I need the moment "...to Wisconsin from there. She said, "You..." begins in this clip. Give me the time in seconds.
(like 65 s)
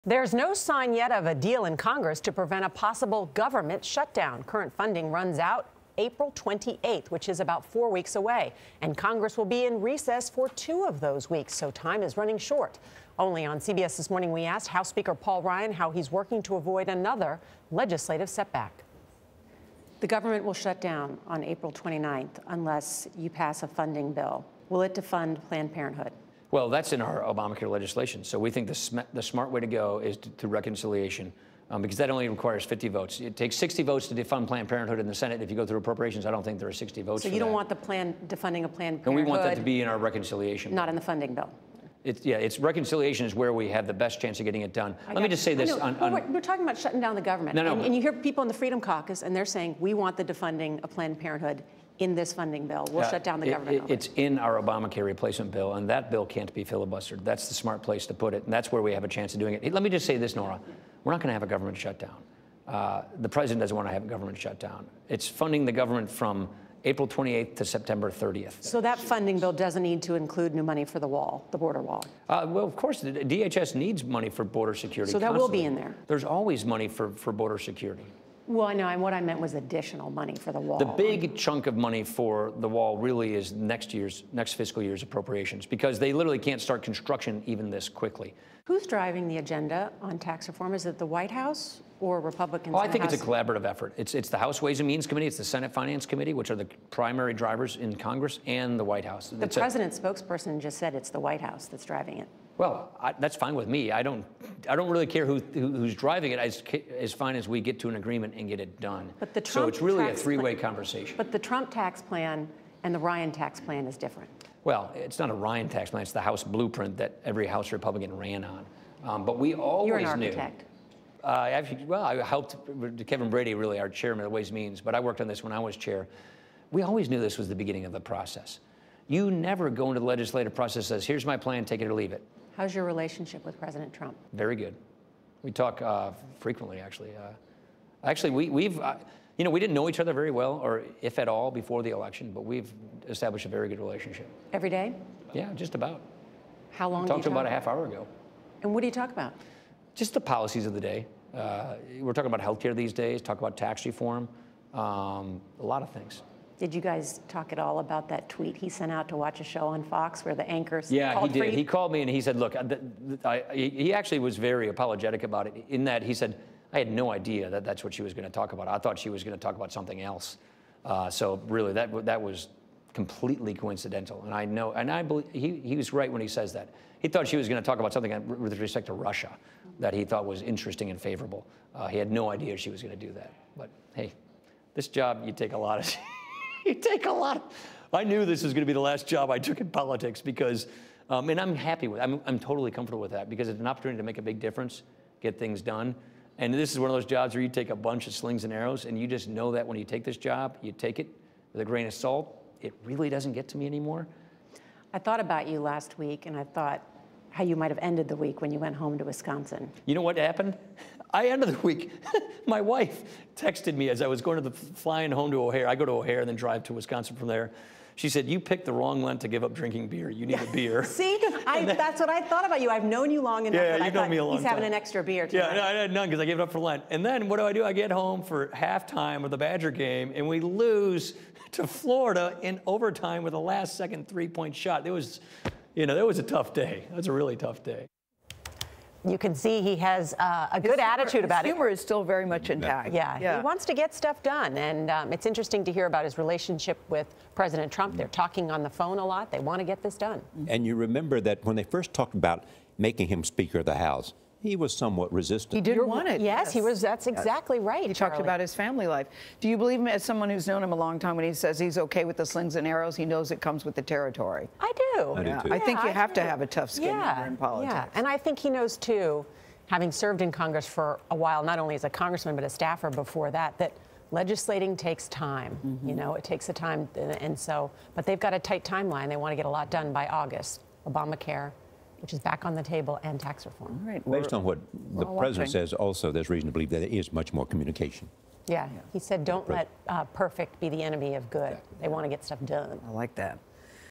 216 s.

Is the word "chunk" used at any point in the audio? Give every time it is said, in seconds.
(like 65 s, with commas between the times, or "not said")
81 s.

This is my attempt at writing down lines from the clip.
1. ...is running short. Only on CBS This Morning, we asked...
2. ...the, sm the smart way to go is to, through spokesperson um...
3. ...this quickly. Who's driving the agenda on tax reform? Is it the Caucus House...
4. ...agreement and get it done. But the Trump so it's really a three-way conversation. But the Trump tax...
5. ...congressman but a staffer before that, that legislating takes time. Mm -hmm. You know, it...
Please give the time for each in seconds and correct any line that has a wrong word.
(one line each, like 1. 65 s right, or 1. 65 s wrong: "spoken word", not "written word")
1. 12 s right
2. 28 s wrong: "reconciliation", not "spokesperson"
3. 87 s wrong: "White", not "Caucus"
4. 107 s right
5. 271 s right.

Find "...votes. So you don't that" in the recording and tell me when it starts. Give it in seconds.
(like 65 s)
37 s.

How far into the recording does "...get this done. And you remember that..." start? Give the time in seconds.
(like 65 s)
249 s.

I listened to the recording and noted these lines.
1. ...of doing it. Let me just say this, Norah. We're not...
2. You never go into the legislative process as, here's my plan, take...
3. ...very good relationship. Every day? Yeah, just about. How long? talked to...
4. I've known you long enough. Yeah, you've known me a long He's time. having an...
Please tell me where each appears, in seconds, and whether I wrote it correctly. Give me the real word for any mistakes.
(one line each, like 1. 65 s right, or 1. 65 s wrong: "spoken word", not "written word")
1. 59 s right
2. 129 s right
3. 143 s right
4. 222 s right.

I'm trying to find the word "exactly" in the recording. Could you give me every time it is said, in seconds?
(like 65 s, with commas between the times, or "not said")
257 s, 291 s.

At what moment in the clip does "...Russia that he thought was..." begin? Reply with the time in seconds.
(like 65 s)
178 s.